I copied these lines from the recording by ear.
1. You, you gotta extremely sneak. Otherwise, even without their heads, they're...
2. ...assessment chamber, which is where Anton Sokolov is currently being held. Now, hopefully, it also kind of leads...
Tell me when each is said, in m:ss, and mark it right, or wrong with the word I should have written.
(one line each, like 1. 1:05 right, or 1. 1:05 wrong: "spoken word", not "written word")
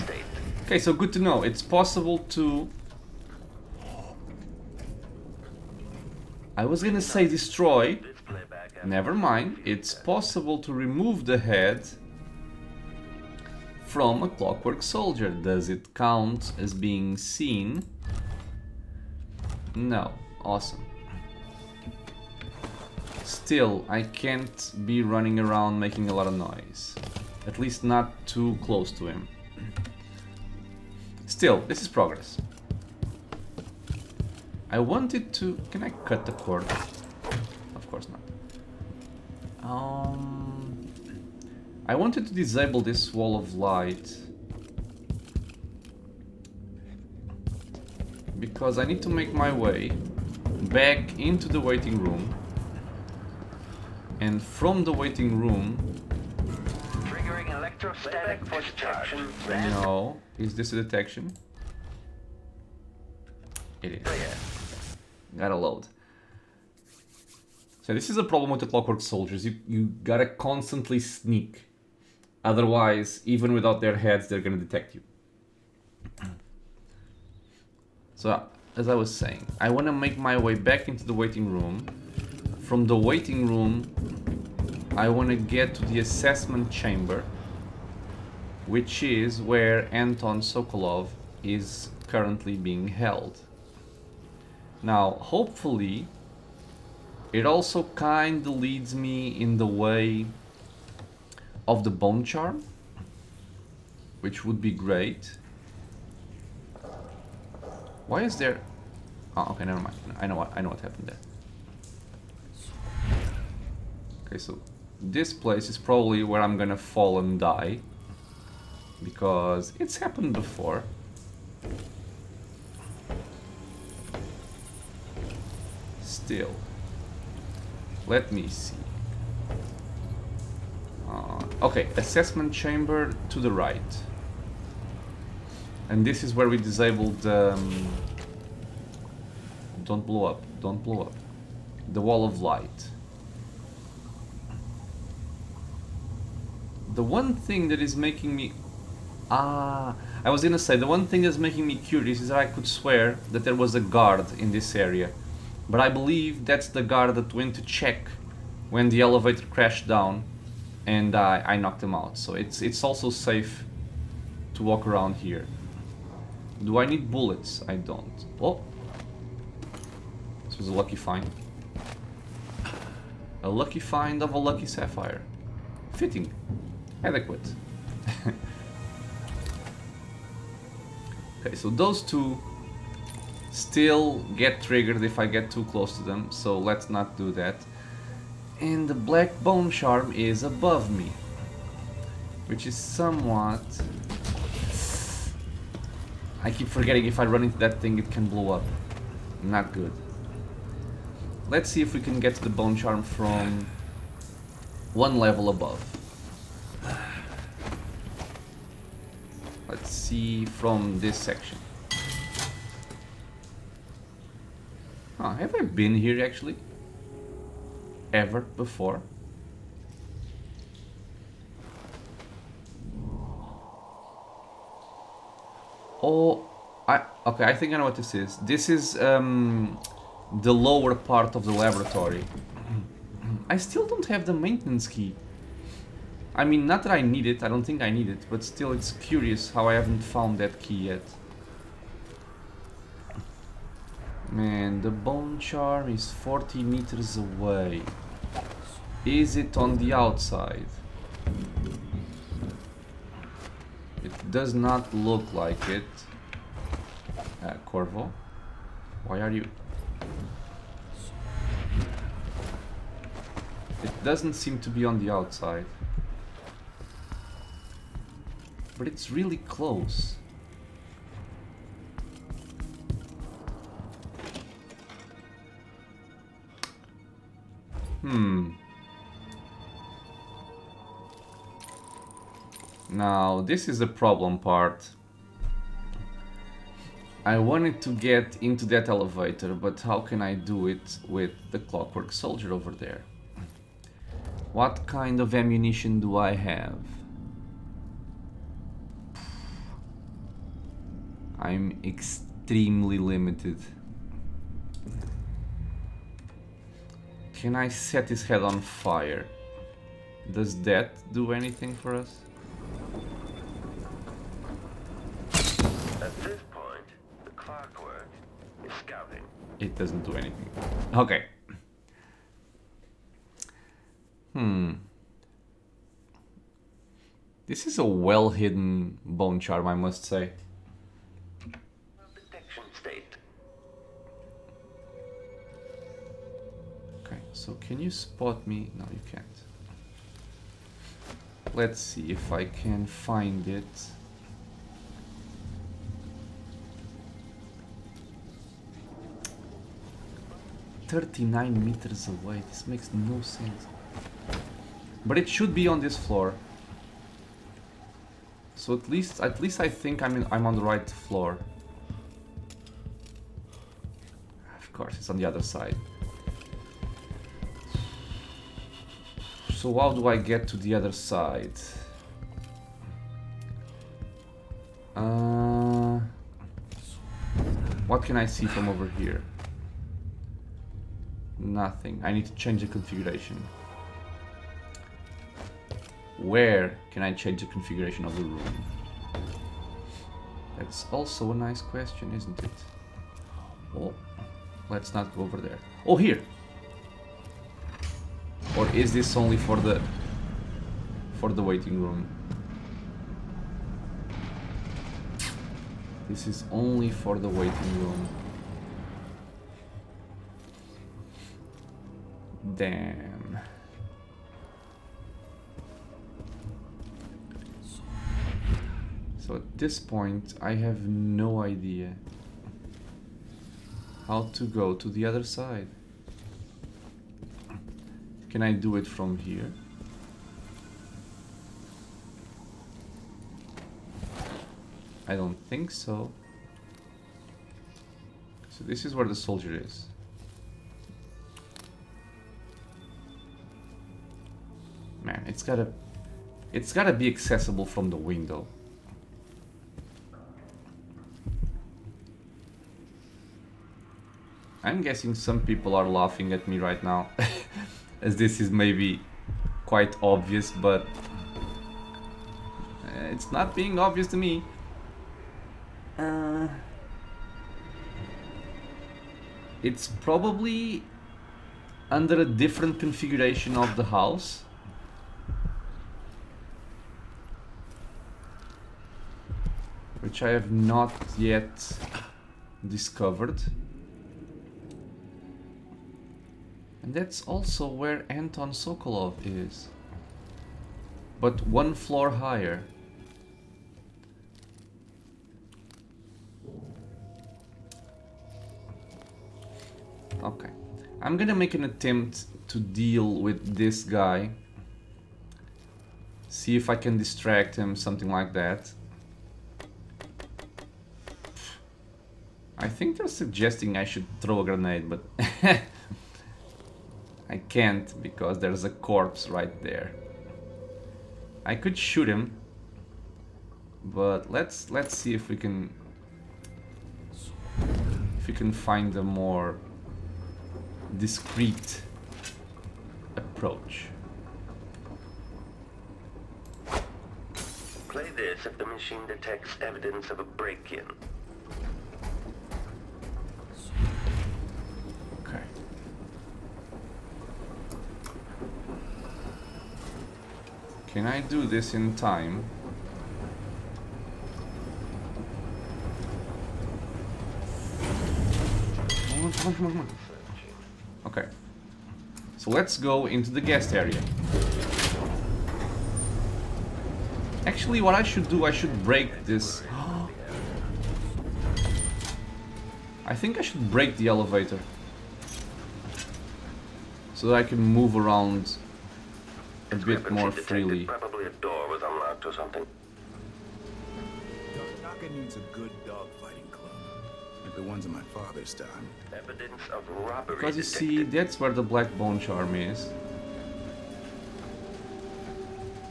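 1. 1:09 wrong: "constantly", not "extremely"
2. 1:26 right.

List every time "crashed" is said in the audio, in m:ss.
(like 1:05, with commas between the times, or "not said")
2:39.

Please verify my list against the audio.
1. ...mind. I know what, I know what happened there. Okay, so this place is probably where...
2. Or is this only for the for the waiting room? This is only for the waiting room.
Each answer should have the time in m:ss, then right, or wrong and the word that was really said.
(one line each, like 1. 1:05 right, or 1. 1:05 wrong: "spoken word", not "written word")
1. 1:49 right
2. 6:38 right.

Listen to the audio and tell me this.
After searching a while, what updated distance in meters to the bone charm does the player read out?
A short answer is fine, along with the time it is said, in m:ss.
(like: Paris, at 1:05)
39, at 5:50.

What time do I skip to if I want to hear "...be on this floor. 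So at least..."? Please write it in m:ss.
5:55.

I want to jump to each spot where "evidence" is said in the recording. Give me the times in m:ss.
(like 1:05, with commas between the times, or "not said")
8:59, 9:49.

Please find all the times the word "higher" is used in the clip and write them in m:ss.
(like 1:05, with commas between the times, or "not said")
8:12.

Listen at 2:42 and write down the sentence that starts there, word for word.
So it's, it's also safe to walk around here.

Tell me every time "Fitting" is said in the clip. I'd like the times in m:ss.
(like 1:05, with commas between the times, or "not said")
2:55.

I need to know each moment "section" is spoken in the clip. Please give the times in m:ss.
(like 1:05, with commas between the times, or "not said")
3:31.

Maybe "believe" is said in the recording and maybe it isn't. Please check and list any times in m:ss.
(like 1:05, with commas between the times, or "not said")
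2:35.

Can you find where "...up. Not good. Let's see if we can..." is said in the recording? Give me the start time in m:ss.
3:18.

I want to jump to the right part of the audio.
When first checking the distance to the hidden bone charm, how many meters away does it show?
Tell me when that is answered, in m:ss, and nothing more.
4:06.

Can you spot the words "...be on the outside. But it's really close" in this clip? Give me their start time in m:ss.
4:24.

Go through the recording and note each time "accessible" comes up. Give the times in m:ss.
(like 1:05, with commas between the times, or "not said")
7:27.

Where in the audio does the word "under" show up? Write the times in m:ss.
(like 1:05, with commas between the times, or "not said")
7:51.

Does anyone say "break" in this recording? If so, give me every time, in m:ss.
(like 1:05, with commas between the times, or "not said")
9:00, 9:28, 9:33.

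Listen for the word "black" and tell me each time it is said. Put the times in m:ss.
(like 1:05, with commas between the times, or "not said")
3:08, 9:51.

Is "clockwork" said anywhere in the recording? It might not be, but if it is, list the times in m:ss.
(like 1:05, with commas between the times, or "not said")
0:14, 1:08, 4:51, 5:17.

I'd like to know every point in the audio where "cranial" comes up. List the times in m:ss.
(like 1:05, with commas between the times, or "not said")
not said.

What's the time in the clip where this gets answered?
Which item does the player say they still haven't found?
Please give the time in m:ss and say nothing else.
3:54.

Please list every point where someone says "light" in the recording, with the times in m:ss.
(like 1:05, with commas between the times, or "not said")
0:43, 2:22.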